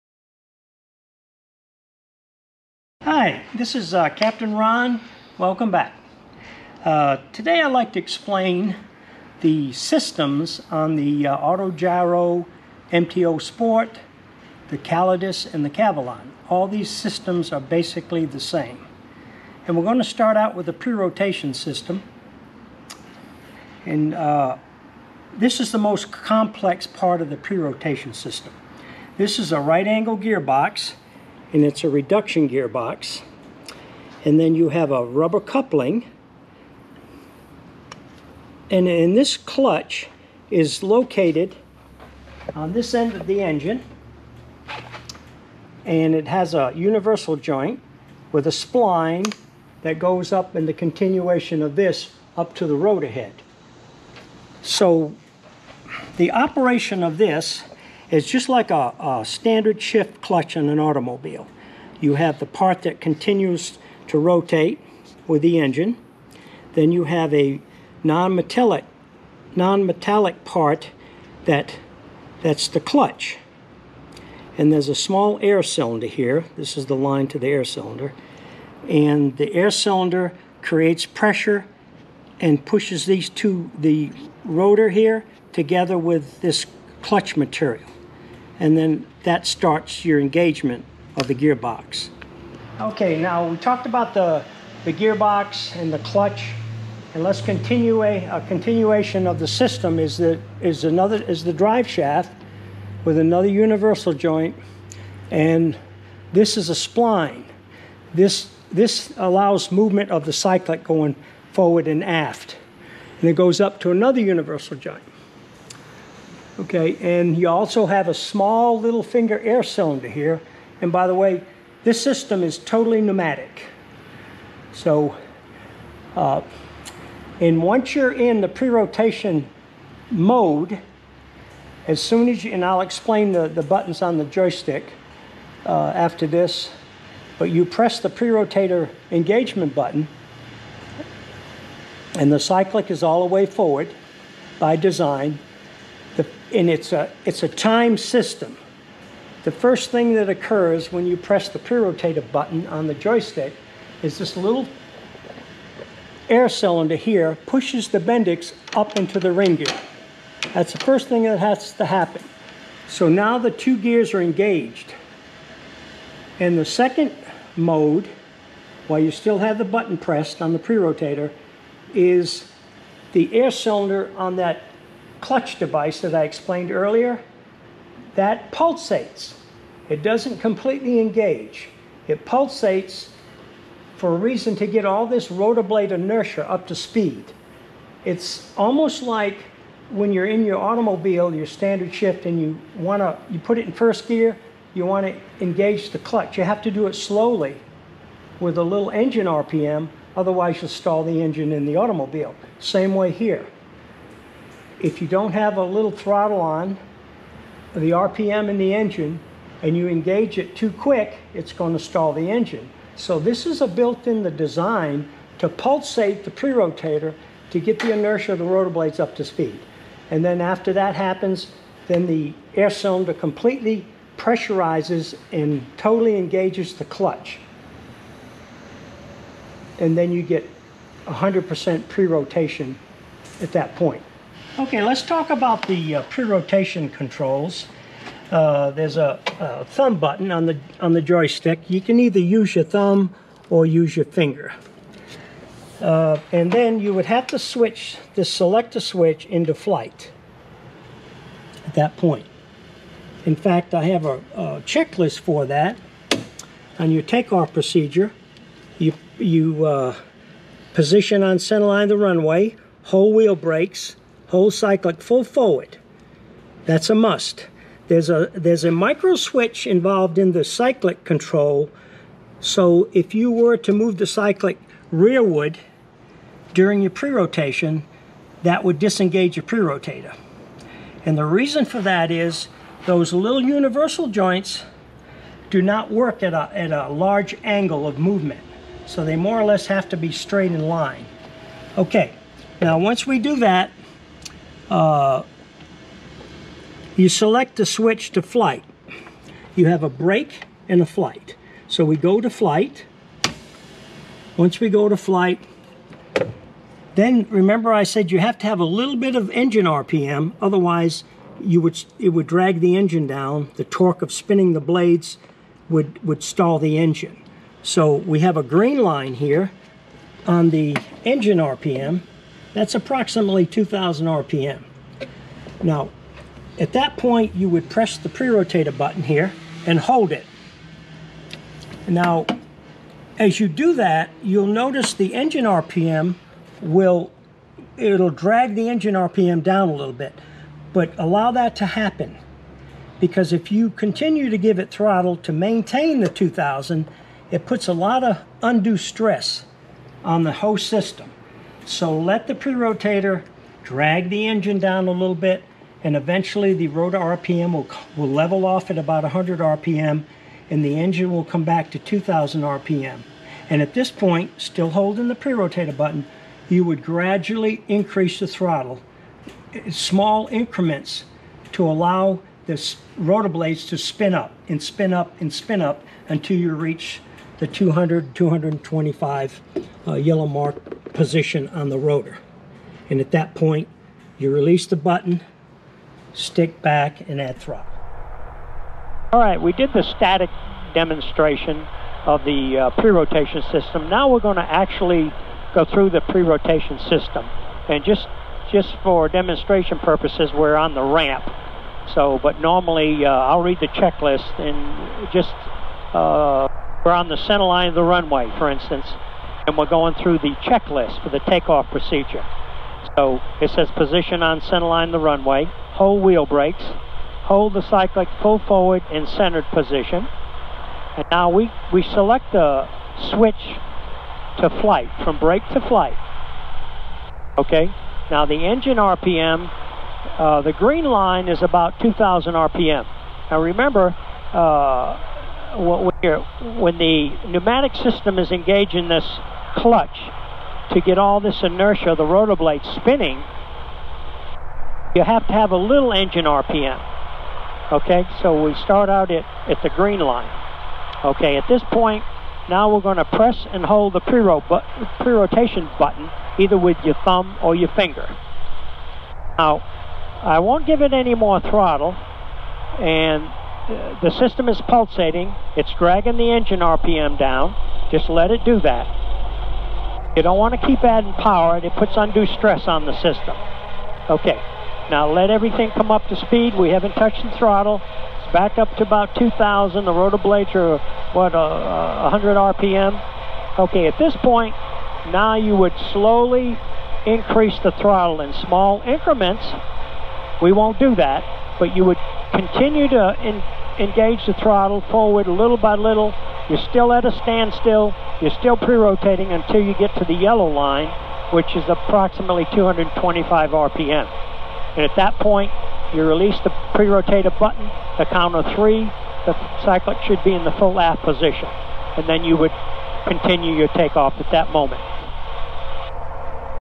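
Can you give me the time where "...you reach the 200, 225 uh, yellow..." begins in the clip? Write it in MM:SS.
06:16.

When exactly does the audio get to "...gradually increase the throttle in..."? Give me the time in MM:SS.
06:06.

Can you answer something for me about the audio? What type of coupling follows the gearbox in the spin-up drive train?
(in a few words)
Rubber coupling.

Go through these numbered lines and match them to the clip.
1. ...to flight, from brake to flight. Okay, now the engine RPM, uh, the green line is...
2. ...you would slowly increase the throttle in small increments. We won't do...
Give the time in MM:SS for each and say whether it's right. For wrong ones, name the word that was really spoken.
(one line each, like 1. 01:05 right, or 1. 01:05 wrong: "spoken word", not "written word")
1. 07:04 right
2. 08:05 right.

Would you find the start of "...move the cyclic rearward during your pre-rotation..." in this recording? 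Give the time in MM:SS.
04:33.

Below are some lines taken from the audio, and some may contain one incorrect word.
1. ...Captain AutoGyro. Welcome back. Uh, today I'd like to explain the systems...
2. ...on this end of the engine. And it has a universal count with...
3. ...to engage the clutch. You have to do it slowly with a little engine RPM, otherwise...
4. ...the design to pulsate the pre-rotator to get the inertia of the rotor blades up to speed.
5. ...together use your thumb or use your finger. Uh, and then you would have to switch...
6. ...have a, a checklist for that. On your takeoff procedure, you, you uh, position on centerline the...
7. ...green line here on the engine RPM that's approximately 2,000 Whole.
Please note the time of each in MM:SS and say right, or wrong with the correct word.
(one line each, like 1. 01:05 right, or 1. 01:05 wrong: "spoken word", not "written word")
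1. 00:04 wrong: "Ron", not "AutoGyro"
2. 00:42 wrong: "joint", not "count"
3. 03:15 right
4. 03:34 right
5. 04:02 wrong: "either", not "together"
6. 04:13 right
7. 05:18 wrong: "RPM", not "Whole".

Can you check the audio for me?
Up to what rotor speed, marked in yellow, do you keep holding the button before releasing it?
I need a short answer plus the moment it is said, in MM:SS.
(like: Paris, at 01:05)
225 RPM, at 08:22.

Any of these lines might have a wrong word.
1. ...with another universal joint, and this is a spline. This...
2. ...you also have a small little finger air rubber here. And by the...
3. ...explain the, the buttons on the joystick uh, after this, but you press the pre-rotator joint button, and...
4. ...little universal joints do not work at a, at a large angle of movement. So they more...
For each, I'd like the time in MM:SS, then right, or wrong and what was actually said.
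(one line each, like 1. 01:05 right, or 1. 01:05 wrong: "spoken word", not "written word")
1. 01:43 right
2. 01:57 wrong: "cylinder", not "rubber"
3. 02:12 wrong: "engagement", not "joint"
4. 04:43 right.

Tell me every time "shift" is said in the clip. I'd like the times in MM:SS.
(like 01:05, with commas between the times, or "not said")
00:59, 03:11.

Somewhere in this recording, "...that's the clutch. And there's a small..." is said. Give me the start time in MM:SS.
01:12.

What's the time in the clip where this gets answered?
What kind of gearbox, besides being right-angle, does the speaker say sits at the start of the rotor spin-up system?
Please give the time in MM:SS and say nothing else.
00:31.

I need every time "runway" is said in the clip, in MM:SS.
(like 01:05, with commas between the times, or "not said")
04:21, 06:47, 06:54.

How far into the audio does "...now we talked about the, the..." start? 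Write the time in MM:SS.
01:33.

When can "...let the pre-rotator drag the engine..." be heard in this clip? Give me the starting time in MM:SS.
05:51.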